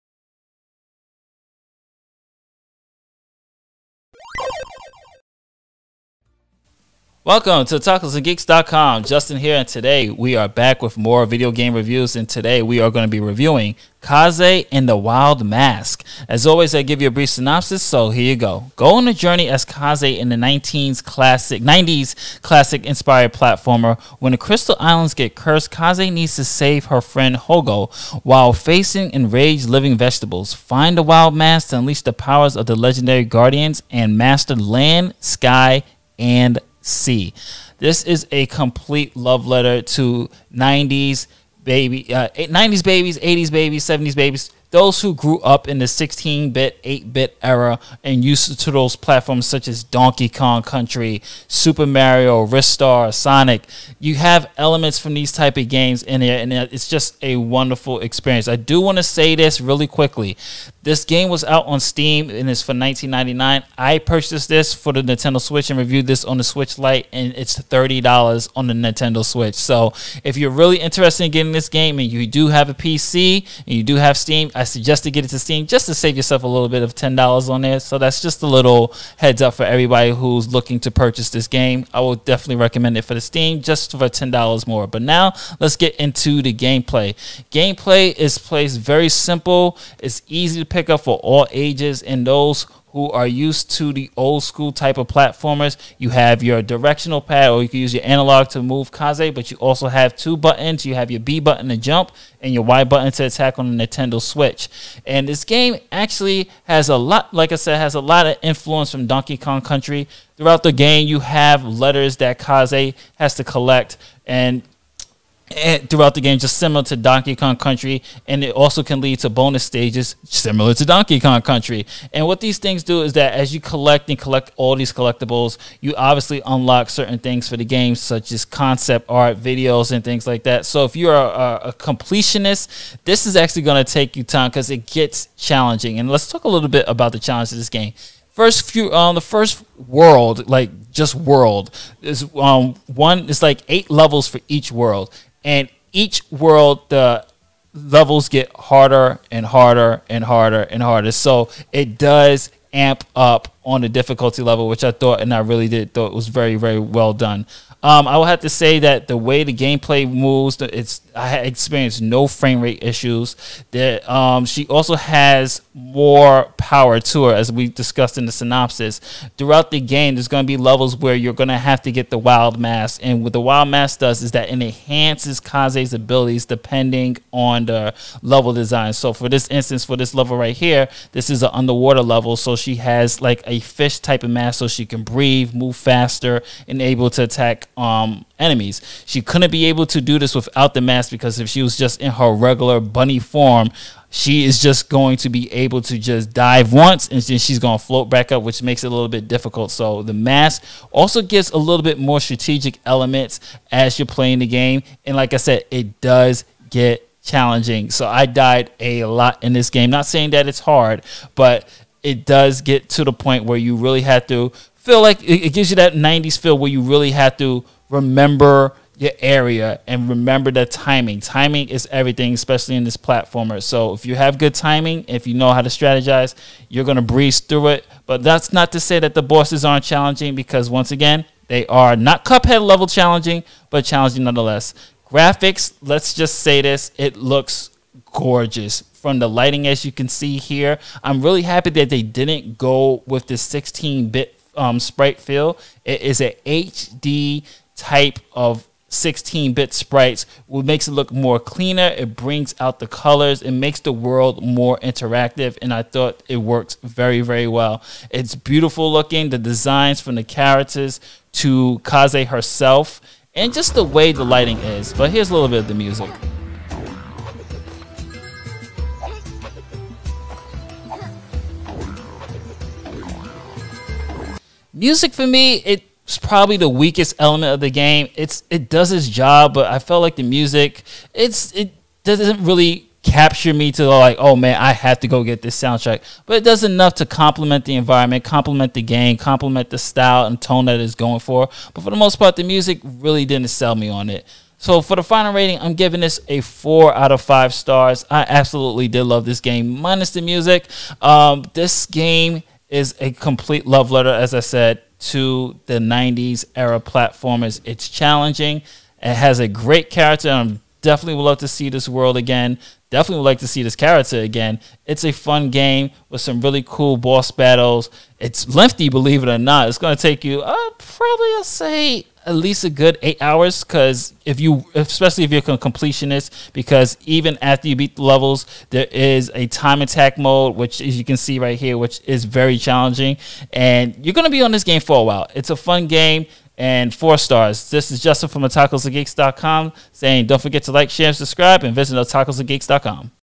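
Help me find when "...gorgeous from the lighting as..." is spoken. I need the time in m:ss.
3:58.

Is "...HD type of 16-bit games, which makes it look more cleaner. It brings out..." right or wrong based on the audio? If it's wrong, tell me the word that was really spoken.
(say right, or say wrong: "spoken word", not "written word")
wrong: "sprites", not "games".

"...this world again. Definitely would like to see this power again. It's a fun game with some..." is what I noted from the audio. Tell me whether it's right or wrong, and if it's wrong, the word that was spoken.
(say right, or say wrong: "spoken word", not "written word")
wrong: "character", not "power".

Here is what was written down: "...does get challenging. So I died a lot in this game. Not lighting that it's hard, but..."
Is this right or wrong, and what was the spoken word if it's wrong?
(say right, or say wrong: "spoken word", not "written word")
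wrong: "saying", not "lighting".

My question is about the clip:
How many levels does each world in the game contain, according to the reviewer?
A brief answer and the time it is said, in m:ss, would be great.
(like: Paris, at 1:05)
8, at 2:23.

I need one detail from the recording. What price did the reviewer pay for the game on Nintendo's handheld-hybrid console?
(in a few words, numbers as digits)
$30.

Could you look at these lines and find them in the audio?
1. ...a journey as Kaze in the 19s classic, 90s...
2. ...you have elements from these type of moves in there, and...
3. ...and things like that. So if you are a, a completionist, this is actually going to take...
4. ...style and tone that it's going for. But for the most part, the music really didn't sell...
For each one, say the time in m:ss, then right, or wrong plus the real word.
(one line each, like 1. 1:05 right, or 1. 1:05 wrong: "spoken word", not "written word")
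1. 0:19 right
2. 0:53 wrong: "games", not "moves"
3. 2:09 right
4. 4:49 right.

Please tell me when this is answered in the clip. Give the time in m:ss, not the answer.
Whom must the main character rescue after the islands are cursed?
0:27.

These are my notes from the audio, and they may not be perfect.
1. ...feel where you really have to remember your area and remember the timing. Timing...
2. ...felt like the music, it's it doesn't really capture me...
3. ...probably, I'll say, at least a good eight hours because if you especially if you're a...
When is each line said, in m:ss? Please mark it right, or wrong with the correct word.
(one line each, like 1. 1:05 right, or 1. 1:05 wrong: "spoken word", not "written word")
1. 3:36 right
2. 4:39 right
3. 5:20 right.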